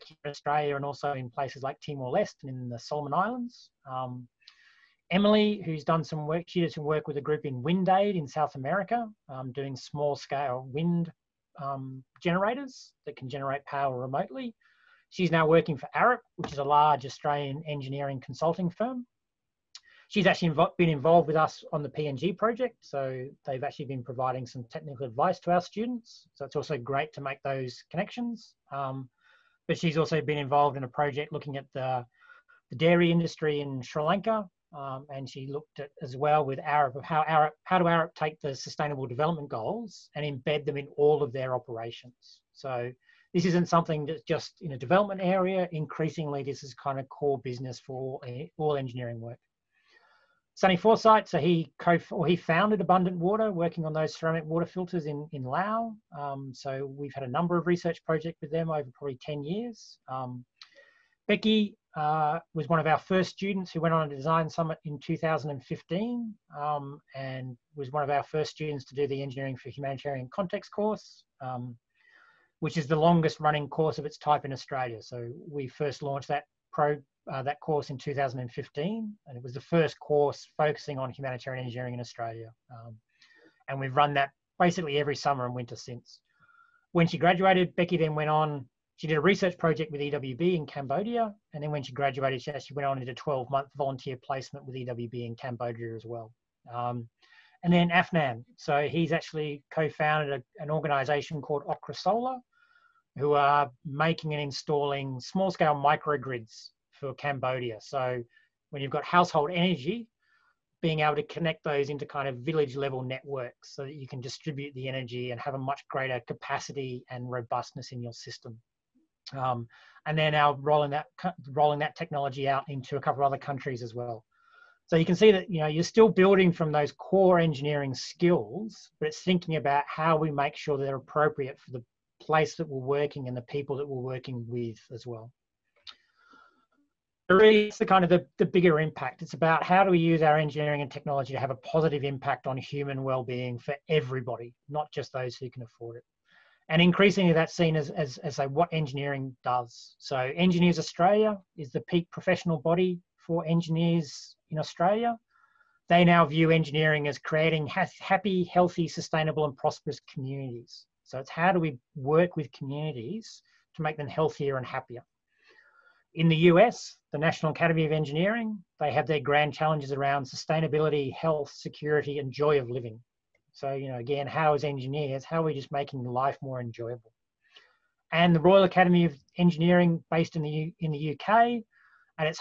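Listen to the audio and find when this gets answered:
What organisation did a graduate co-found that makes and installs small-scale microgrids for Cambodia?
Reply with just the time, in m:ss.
1:41.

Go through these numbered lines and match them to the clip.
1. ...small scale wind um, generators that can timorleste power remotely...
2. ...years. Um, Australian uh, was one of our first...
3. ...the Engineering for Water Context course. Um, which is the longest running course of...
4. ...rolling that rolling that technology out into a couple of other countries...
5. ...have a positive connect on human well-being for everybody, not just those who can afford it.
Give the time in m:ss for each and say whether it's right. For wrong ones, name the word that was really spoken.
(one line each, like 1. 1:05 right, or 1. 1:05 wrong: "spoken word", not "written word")
1. 0:09 wrong: "generate", not "timorleste"
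2. 0:59 wrong: "Becky", not "Australian"
3. 1:09 wrong: "Humanitarian", not "Water"
4. 2:00 right
5. 2:21 wrong: "impact", not "connect".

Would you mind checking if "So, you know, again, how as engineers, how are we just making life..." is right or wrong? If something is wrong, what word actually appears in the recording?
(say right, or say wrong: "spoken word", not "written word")
right.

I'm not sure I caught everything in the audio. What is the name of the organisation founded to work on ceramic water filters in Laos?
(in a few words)
Abundant Water.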